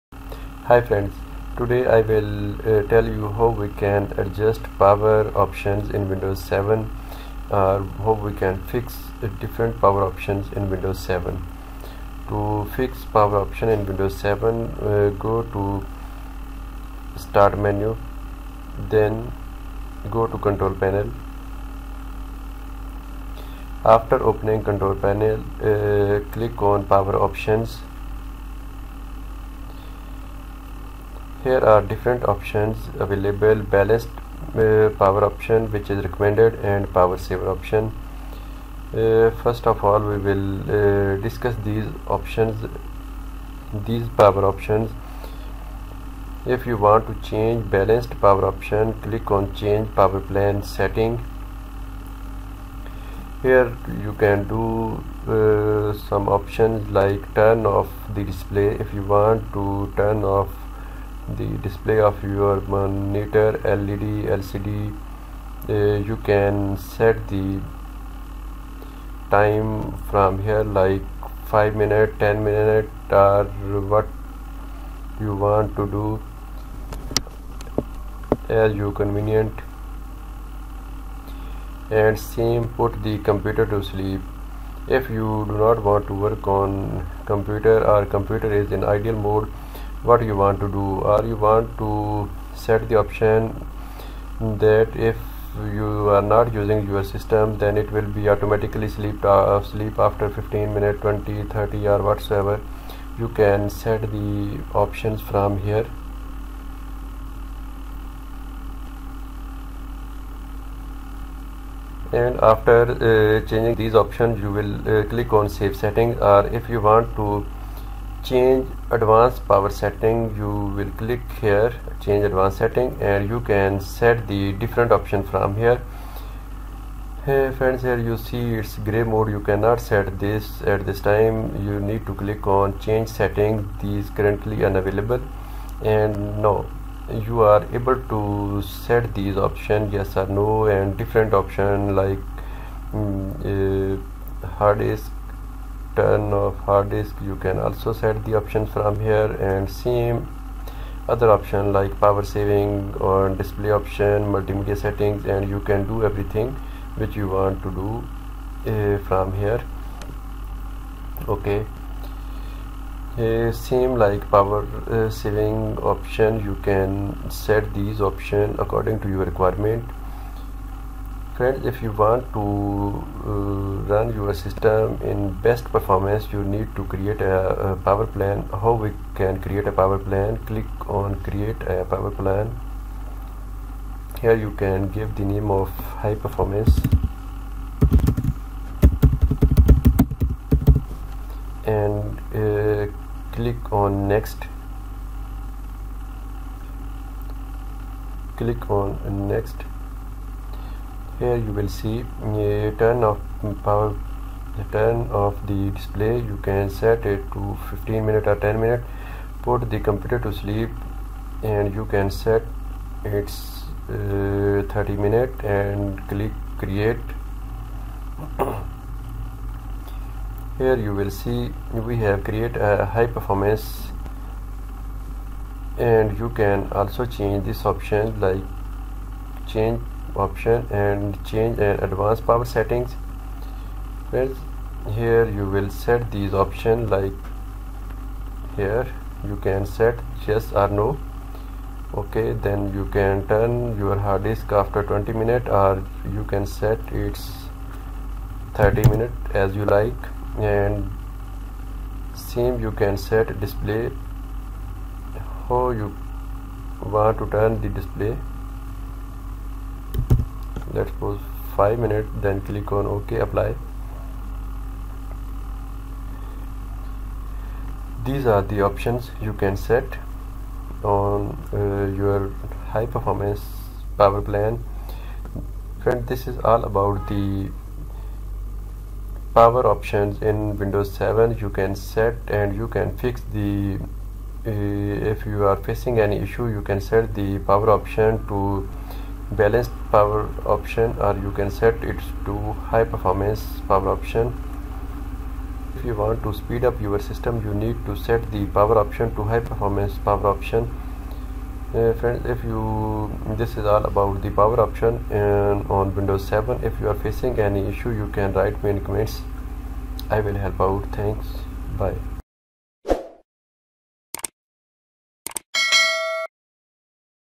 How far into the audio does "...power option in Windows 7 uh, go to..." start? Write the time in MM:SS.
00:13.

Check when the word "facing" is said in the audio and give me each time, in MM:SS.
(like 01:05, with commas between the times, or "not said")
04:45, 05:07.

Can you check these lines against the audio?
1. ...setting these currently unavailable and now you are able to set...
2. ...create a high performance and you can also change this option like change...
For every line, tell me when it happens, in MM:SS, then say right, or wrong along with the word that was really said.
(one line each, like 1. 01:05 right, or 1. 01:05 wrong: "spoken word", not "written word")
1. 02:13 right
2. 03:42 right.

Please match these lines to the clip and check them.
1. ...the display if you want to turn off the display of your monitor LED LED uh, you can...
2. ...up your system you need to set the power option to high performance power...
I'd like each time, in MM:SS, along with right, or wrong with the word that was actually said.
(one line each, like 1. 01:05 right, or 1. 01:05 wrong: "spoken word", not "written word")
1. 00:58 wrong: "LCD", not "LED"
2. 04:56 right.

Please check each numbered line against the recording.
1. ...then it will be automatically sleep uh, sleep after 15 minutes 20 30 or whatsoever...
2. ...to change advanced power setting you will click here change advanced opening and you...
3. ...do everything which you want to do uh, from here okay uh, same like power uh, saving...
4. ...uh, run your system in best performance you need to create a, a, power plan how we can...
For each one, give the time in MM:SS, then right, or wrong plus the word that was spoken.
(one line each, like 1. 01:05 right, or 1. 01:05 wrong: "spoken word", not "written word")
1. 01:37 right
2. 01:57 wrong: "setting", not "opening"
3. 02:35 right
4. 02:53 right.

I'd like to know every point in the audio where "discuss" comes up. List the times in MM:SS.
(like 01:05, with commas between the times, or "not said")
00:41.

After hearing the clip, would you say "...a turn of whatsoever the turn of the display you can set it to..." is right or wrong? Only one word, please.
wrong.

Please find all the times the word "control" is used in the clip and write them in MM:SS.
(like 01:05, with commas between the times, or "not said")
00:20, 00:24.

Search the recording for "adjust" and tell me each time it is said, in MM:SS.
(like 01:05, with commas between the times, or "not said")
00:04.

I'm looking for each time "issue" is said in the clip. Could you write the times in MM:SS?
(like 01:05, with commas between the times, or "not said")
04:46, 05:07.